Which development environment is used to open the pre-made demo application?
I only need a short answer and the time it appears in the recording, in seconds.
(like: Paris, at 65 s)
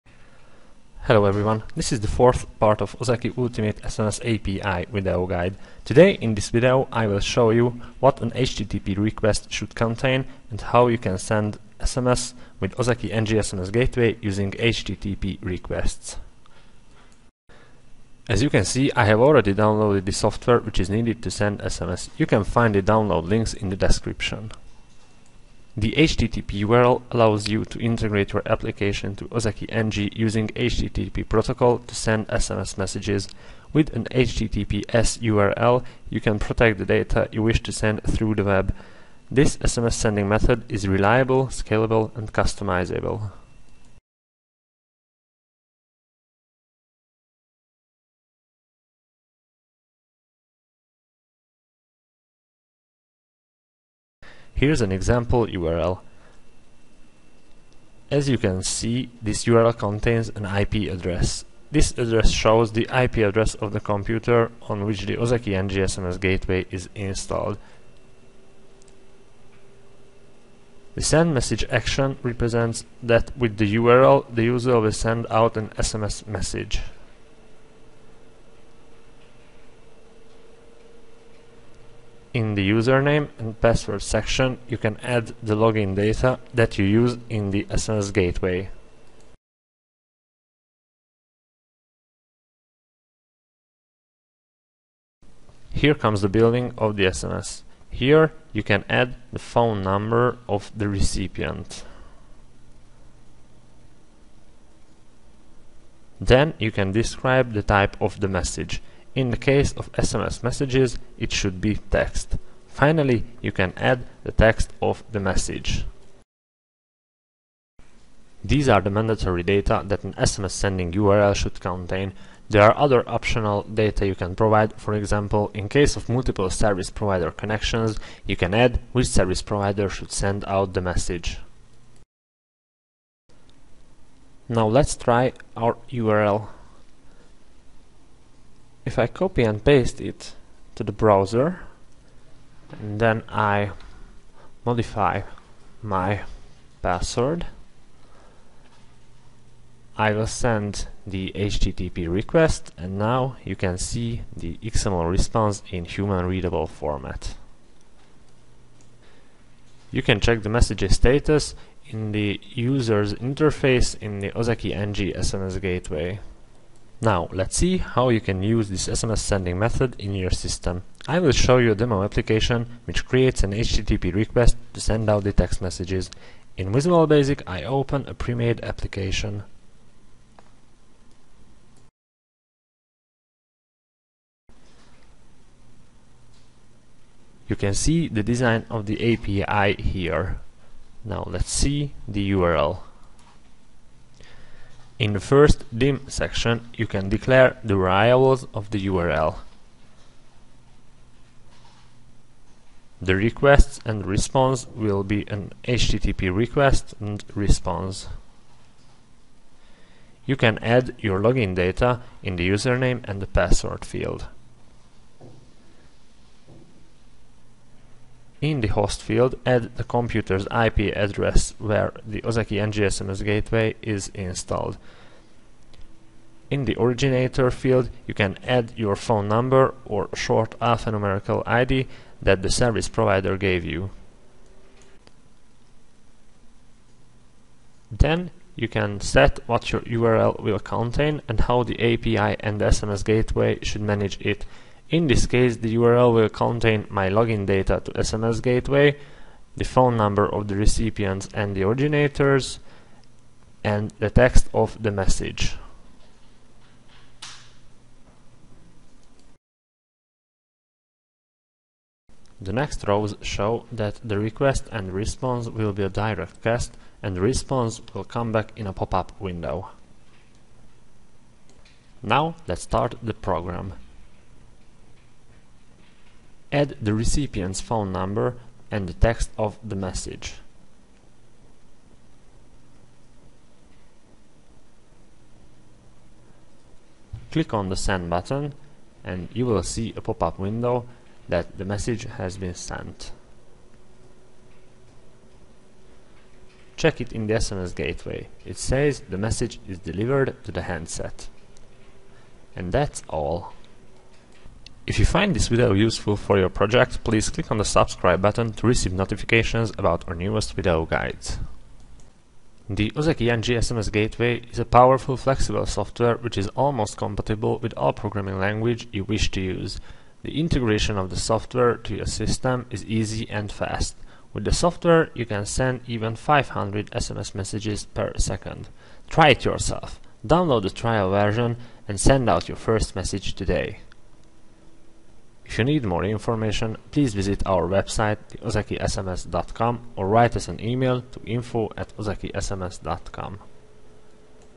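Visual Basic, at 176 s.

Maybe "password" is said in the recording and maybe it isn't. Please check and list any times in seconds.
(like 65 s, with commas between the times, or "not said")
83 s, 146 s, 213 s.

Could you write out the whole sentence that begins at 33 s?
With an HTTPS URL, you can protect the data you wish to send through the web.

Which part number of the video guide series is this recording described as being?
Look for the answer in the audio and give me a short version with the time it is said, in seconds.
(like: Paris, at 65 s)
fourth, at 2 s.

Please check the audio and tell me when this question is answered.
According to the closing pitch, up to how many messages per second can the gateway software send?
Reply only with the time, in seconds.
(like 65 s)
326 s.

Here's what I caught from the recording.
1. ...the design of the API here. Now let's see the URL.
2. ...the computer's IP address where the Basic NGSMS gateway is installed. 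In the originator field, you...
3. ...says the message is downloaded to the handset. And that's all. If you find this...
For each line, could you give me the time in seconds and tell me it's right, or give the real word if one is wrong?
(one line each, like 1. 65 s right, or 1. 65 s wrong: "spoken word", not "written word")
1. 188 s right
2. 219 s wrong: "Ozeki", not "Basic"
3. 298 s wrong: "delivered", not "downloaded".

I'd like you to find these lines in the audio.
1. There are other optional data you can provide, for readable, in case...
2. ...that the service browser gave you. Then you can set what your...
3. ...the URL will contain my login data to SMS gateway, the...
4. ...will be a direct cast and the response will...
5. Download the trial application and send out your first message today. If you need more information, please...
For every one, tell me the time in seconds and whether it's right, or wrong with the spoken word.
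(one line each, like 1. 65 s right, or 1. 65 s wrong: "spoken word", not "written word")
1. 122 s wrong: "example", not "readable"
2. 232 s wrong: "provider", not "browser"
3. 245 s right
4. 265 s right
5. 330 s wrong: "version", not "application".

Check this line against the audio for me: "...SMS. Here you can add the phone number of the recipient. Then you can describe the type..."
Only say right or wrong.
right.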